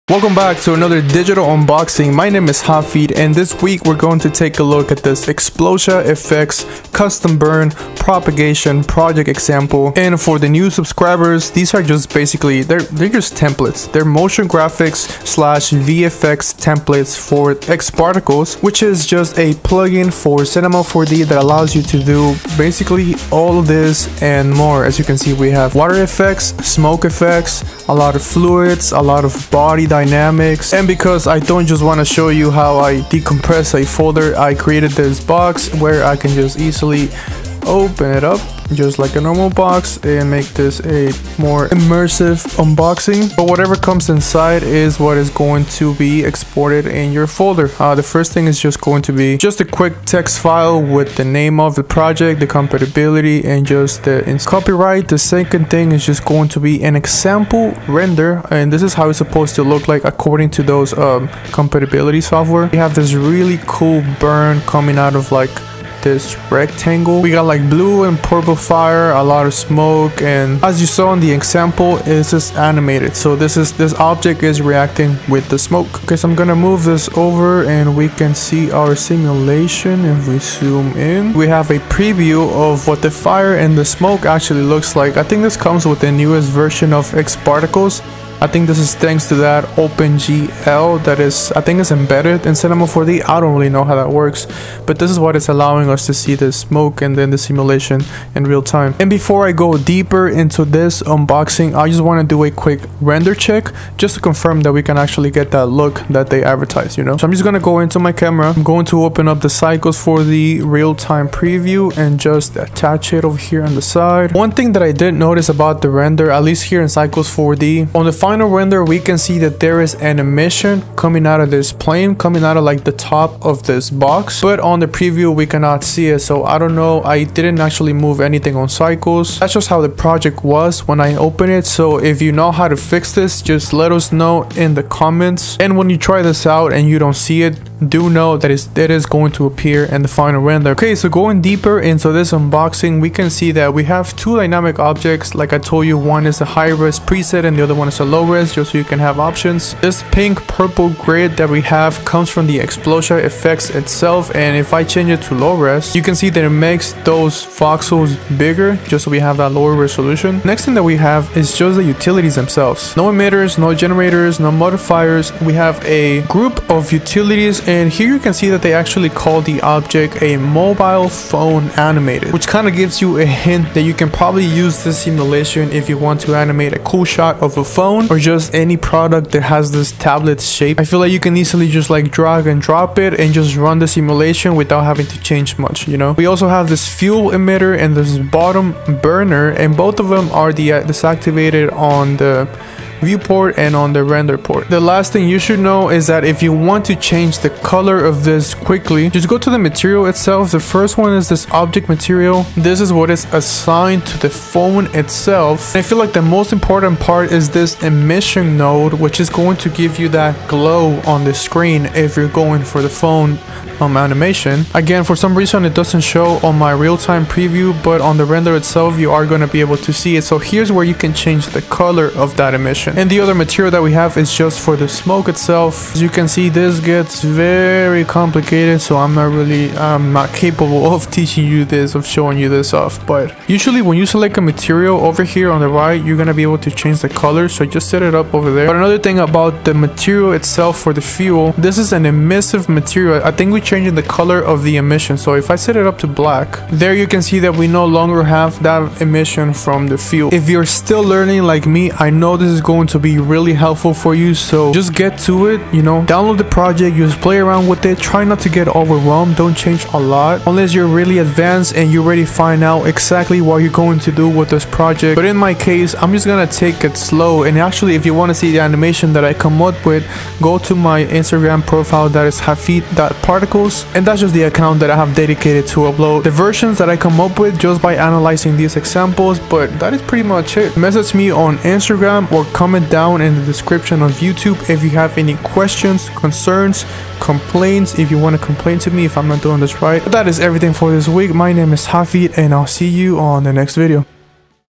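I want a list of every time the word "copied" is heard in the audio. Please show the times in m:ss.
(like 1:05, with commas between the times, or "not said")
not said.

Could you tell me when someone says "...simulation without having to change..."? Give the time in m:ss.
3:03.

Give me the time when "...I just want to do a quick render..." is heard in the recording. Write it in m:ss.
1:41.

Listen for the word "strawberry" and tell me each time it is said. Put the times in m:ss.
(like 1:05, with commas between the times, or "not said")
not said.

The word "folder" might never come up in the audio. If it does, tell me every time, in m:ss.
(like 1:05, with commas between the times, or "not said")
0:33, 0:47.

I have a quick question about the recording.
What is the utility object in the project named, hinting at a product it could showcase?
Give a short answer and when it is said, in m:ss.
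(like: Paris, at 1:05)
mobile phone animated, at 2:50.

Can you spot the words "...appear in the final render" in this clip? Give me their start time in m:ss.
2:19.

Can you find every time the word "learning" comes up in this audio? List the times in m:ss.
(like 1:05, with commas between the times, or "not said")
4:11.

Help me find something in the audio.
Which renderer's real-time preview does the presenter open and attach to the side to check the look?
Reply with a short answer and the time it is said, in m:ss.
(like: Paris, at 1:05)
Cycles 4D, at 1:56.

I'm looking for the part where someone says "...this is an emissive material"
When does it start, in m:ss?
4:01.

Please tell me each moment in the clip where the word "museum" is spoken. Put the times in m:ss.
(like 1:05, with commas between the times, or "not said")
not said.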